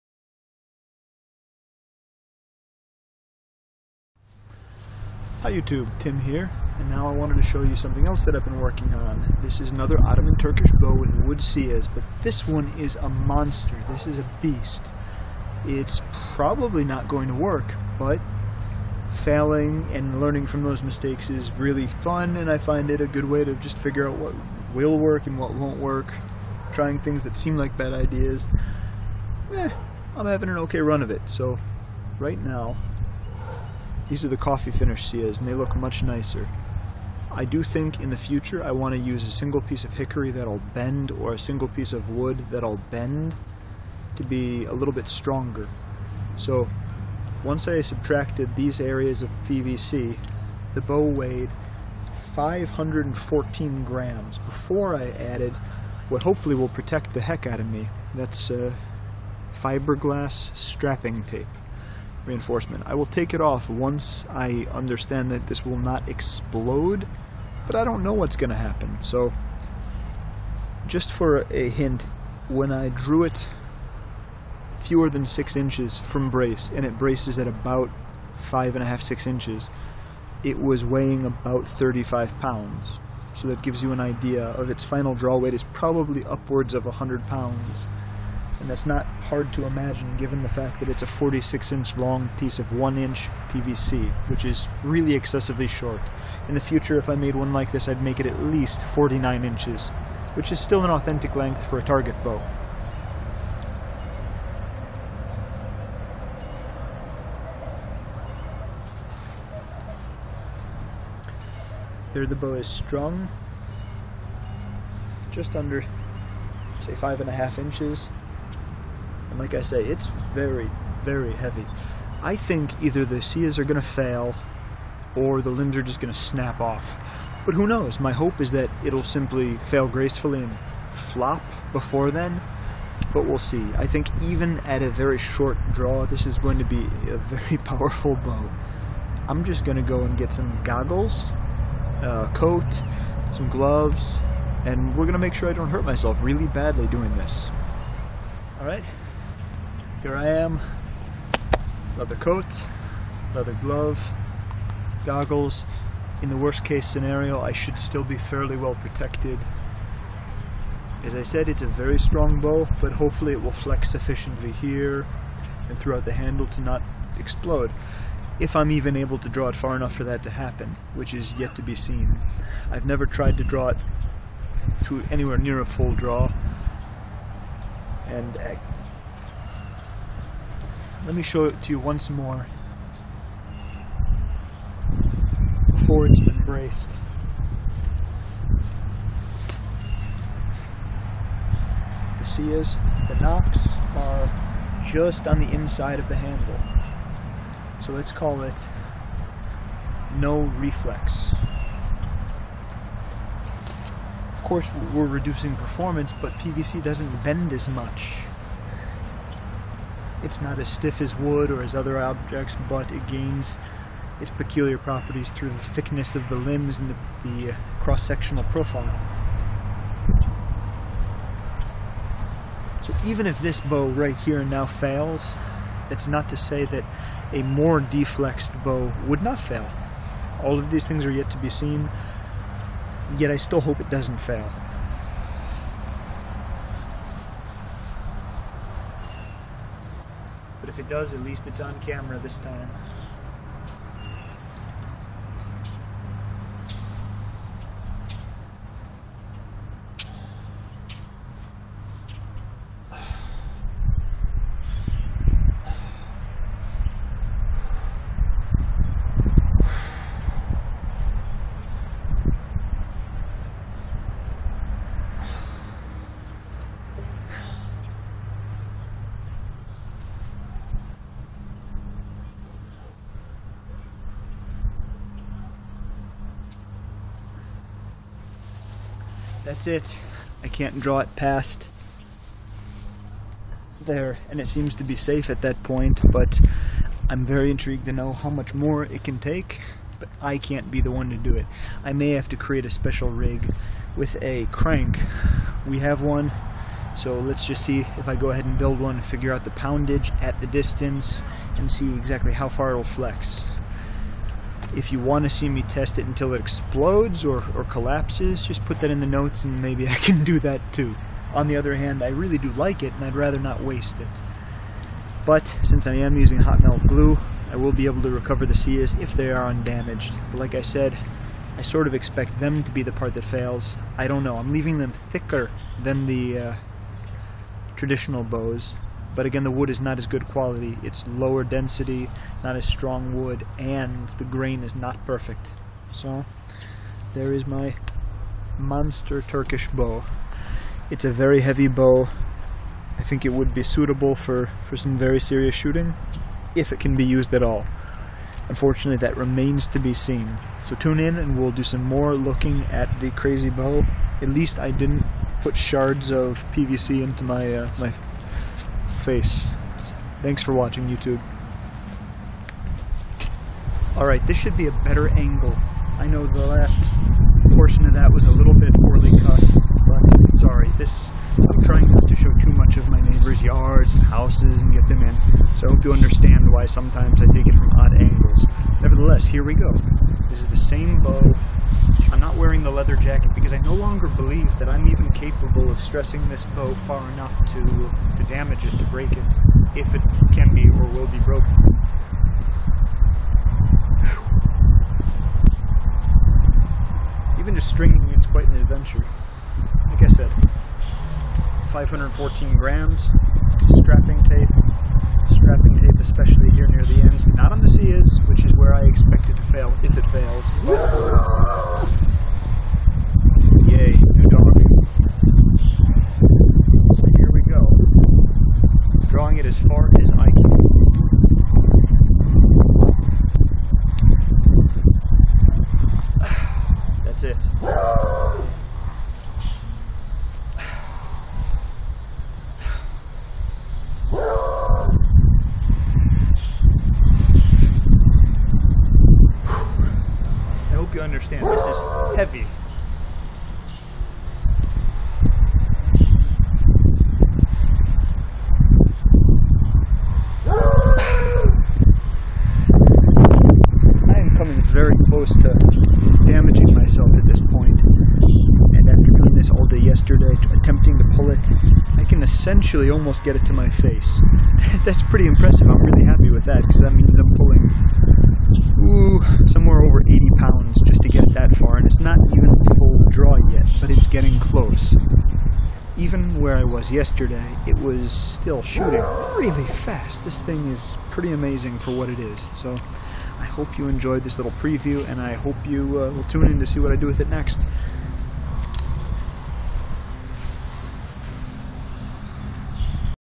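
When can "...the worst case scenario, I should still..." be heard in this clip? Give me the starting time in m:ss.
2:36.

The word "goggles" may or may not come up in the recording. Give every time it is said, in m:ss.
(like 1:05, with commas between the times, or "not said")
2:20, 2:35.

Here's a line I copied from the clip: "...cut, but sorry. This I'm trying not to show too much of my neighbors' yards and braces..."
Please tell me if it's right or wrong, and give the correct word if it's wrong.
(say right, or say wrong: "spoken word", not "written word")
wrong: "houses", not "braces".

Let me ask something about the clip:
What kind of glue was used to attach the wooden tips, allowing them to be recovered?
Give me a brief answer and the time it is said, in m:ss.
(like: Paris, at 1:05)
hot melt glue, at 5:16.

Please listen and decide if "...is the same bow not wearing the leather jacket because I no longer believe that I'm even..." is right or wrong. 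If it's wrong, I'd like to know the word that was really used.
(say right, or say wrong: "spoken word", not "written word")
right.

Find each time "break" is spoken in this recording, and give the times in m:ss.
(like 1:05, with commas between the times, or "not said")
6:28.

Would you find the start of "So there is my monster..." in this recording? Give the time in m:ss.
5:35.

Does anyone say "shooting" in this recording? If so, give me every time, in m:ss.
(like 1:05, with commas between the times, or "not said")
5:45, 7:58.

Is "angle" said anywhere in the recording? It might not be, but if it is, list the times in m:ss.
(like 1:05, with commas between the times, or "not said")
6:05, 6:17.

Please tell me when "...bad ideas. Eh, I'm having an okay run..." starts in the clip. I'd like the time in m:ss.
0:27.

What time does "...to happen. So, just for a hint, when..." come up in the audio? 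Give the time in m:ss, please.
1:08.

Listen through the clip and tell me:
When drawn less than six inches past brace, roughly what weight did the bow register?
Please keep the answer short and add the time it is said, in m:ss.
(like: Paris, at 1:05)
35 pounds, at 1:21.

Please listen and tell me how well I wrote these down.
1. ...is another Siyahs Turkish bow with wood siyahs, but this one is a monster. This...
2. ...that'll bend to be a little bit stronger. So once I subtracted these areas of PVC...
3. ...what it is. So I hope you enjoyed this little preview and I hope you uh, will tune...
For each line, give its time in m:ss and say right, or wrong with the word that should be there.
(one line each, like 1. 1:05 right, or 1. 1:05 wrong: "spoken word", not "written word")
1. 0:09 wrong: "Ottoman", not "Siyahs"
2. 0:42 right
3. 8:01 right.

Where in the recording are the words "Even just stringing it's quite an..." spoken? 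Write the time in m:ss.
6:37.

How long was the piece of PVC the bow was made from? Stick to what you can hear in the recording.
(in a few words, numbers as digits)
46 inches.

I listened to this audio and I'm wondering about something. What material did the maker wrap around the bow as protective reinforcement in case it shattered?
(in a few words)
fiberglass strapping tape.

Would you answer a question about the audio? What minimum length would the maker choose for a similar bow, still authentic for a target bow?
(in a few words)
49 inches.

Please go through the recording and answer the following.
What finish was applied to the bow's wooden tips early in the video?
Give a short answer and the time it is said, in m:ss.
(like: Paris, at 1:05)
coffee finish, at 0:34.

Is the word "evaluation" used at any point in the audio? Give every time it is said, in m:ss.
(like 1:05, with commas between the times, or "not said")
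not said.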